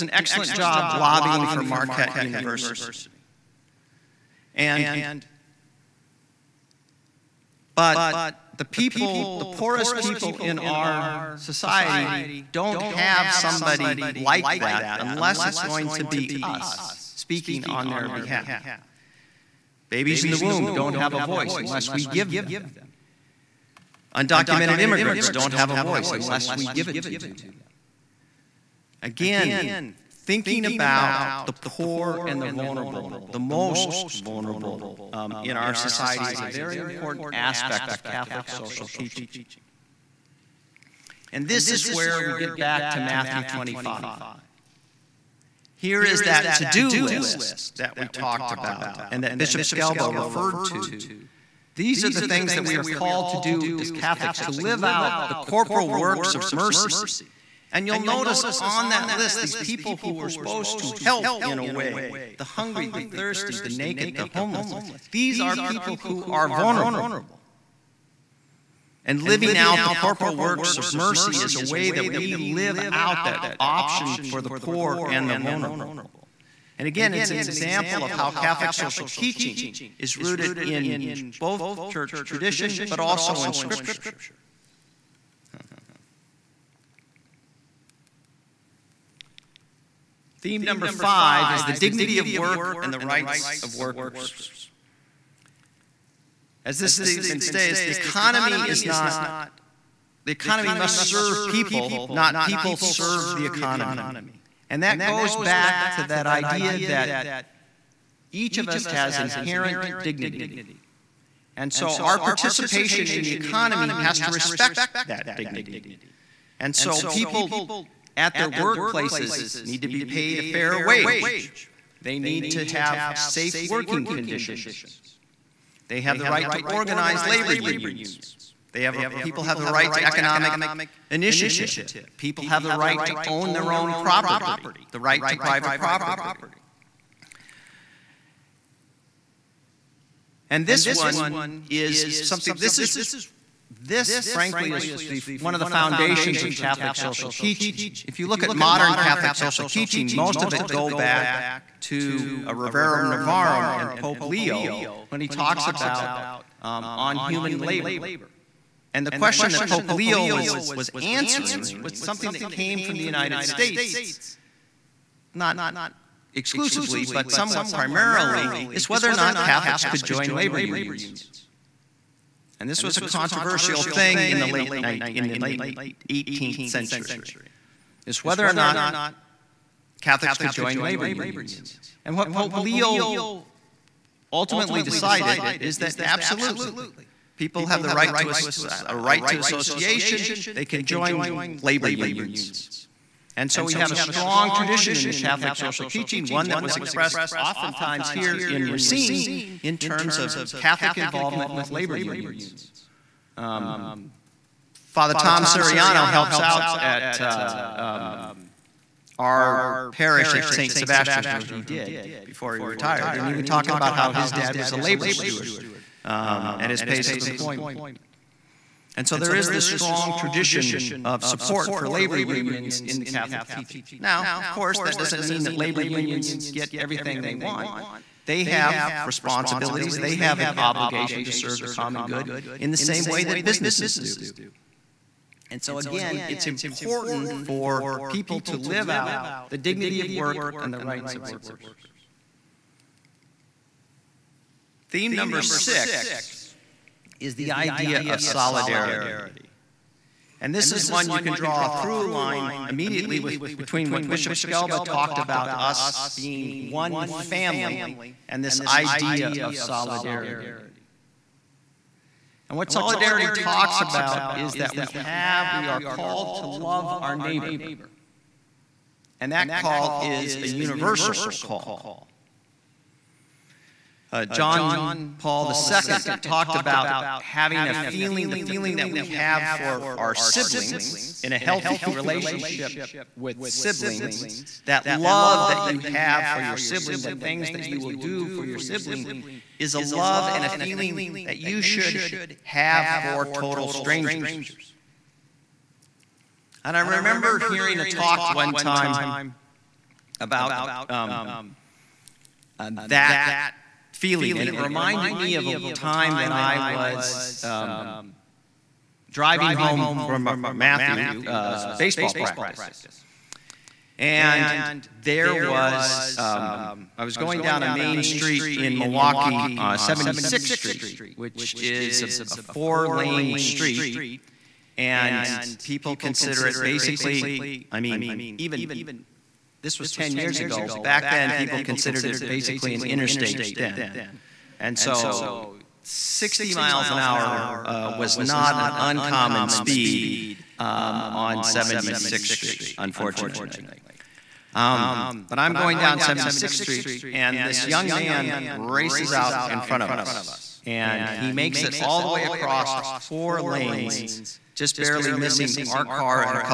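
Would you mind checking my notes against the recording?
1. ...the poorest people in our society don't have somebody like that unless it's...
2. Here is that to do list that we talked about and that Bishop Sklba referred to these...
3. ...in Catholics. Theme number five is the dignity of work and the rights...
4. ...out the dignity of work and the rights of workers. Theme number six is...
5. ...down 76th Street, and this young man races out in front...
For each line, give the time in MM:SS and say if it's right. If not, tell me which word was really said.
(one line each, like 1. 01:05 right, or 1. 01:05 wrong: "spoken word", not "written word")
1. 00:09 right
2. 00:45 right
3. 01:23 wrong: "Scripture", not "Catholics"
4. 03:58 right
5. 05:45 right.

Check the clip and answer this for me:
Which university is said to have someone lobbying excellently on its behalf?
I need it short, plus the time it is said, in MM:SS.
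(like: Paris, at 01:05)
Marquette University, at 00:01.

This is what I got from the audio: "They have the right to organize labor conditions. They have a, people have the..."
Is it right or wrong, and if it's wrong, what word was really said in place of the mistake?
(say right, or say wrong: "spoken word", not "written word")
wrong: "unions", not "conditions".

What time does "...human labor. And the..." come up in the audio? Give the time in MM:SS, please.
02:37.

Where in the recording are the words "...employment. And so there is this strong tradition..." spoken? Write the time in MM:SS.
03:37.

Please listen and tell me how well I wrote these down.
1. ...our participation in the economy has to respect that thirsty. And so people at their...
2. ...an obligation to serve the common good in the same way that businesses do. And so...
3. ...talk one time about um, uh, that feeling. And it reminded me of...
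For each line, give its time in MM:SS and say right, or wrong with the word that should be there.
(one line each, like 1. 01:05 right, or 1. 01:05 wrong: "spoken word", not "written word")
1. 01:51 wrong: "dignity", not "thirsty"
2. 03:50 right
3. 04:57 right.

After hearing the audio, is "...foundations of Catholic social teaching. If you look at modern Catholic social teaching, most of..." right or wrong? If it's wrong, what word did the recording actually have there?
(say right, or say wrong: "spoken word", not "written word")
right.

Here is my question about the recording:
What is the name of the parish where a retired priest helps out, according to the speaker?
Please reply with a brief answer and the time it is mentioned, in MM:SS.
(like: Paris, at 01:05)
St. Sebastian's, at 03:30.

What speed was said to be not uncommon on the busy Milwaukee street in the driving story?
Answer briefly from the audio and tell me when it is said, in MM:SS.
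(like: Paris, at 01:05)
60 miles an hour, at 05:35.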